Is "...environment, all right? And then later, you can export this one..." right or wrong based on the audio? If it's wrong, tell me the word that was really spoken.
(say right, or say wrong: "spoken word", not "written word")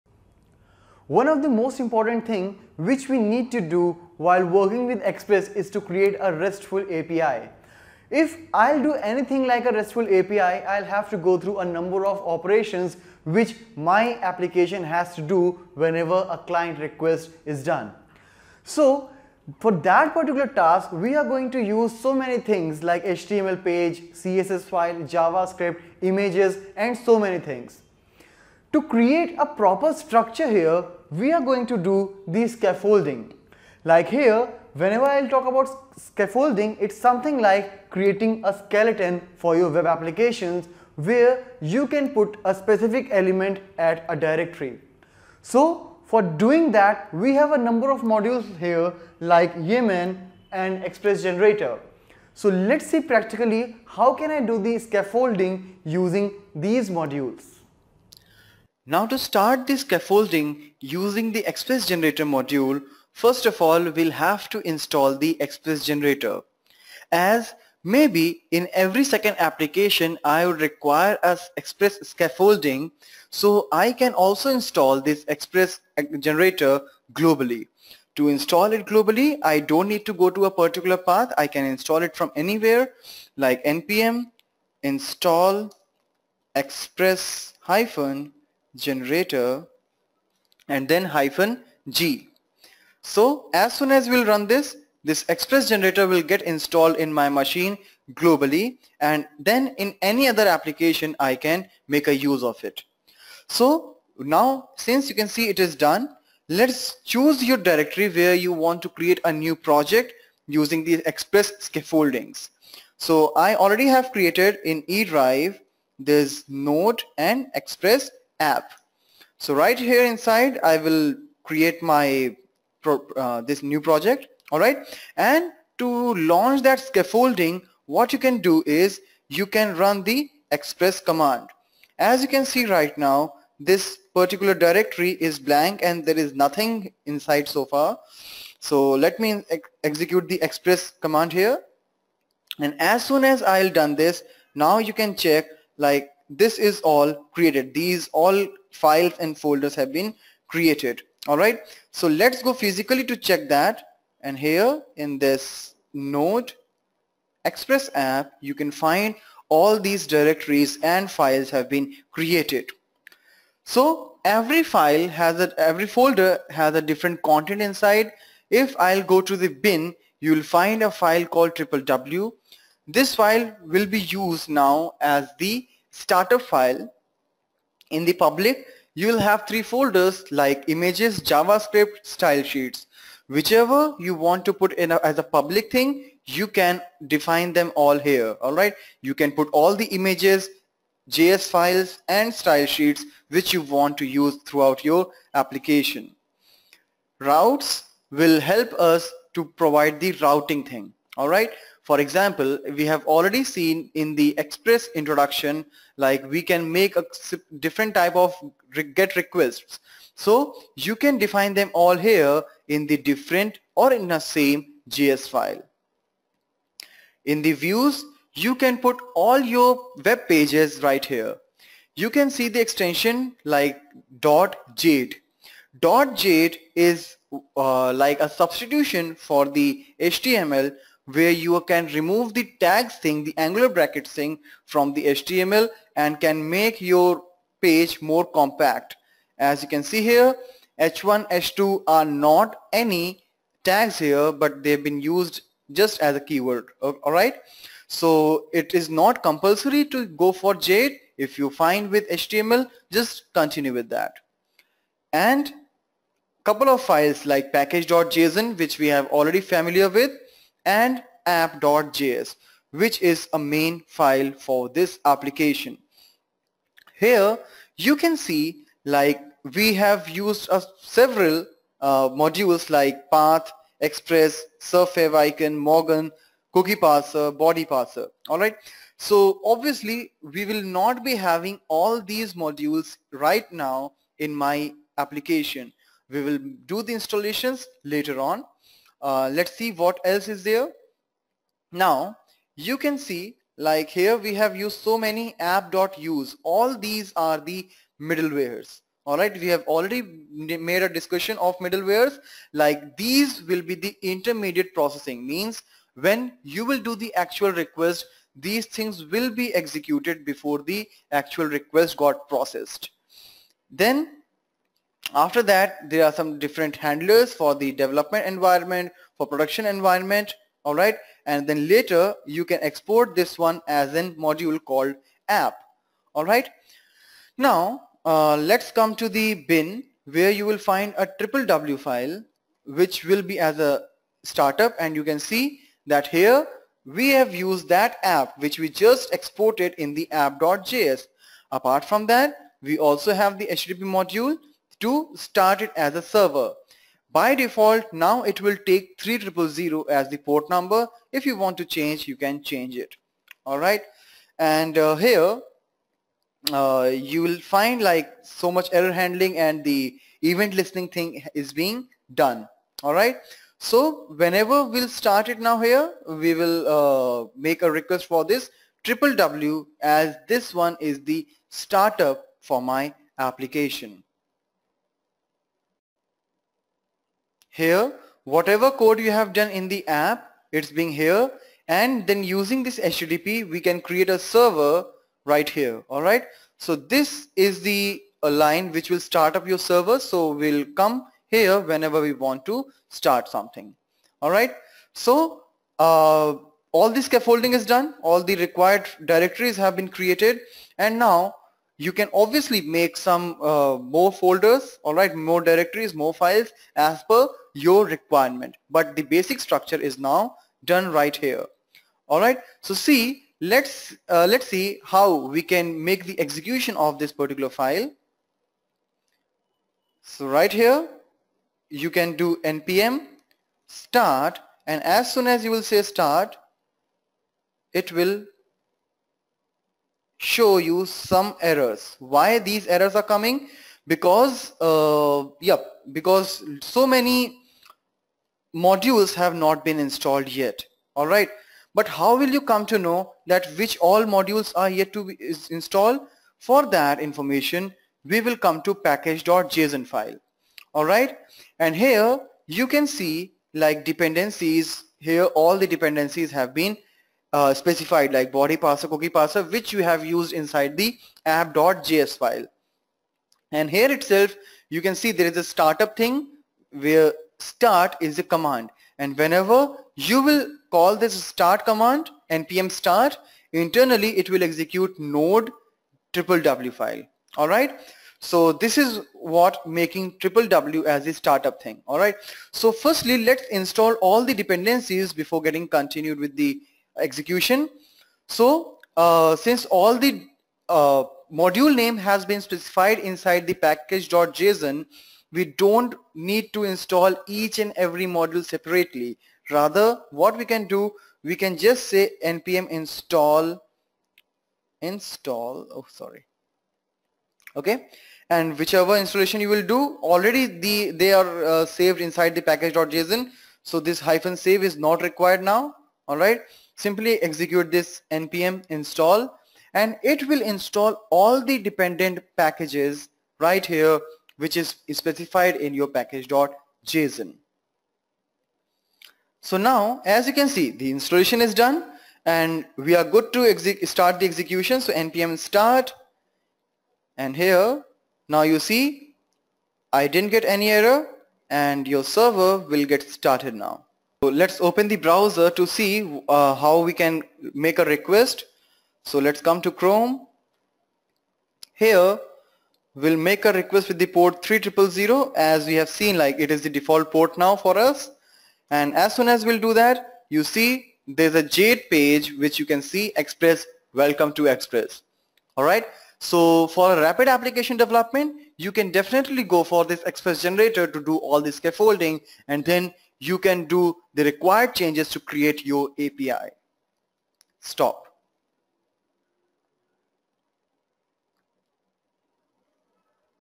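right.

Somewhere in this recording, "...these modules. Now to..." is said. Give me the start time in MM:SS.
00:56.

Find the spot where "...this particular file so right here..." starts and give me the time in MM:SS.
06:56.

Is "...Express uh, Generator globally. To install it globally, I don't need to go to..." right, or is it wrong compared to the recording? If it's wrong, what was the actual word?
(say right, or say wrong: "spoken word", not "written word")
right.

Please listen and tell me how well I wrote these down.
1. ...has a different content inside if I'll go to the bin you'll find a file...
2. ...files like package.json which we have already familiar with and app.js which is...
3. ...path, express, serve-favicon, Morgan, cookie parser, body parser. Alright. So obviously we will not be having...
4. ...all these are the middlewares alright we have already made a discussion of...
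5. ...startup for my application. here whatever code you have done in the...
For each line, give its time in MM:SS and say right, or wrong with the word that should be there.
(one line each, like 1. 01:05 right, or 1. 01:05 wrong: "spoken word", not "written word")
1. 02:46 right
2. 04:16 right
3. 04:33 right
4. 04:56 right
5. 06:11 right.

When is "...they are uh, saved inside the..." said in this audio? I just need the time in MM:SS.
08:30.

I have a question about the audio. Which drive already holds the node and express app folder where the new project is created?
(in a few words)
eDrive.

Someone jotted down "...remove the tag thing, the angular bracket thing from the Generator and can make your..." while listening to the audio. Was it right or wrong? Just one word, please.
wrong.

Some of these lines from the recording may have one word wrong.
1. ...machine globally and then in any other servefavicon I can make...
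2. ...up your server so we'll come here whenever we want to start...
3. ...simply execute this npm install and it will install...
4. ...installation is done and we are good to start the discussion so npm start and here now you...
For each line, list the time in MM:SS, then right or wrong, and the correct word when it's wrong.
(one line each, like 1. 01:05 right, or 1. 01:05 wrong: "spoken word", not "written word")
1. 01:37 wrong: "application", not "servefavicon"
2. 06:29 right
3. 08:36 right
4. 08:50 wrong: "execution", not "discussion".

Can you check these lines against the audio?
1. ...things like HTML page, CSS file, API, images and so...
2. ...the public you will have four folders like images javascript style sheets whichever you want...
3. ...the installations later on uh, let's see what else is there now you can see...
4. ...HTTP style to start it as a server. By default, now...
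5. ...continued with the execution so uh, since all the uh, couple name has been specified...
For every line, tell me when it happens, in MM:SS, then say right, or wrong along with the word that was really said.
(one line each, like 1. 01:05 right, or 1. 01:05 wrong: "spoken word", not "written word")
1. 00:22 wrong: "JavaScript", not "API"
2. 02:58 wrong: "three", not "four"
3. 04:46 right
4. 05:43 wrong: "module", not "style"
5. 08:05 wrong: "module", not "couple".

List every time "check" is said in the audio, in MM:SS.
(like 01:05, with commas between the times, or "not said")
02:25, 02:33.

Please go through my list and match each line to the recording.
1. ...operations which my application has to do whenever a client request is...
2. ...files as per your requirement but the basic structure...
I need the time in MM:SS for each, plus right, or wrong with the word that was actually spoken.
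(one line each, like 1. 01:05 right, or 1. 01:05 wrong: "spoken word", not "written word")
1. 00:12 right
2. 06:46 right.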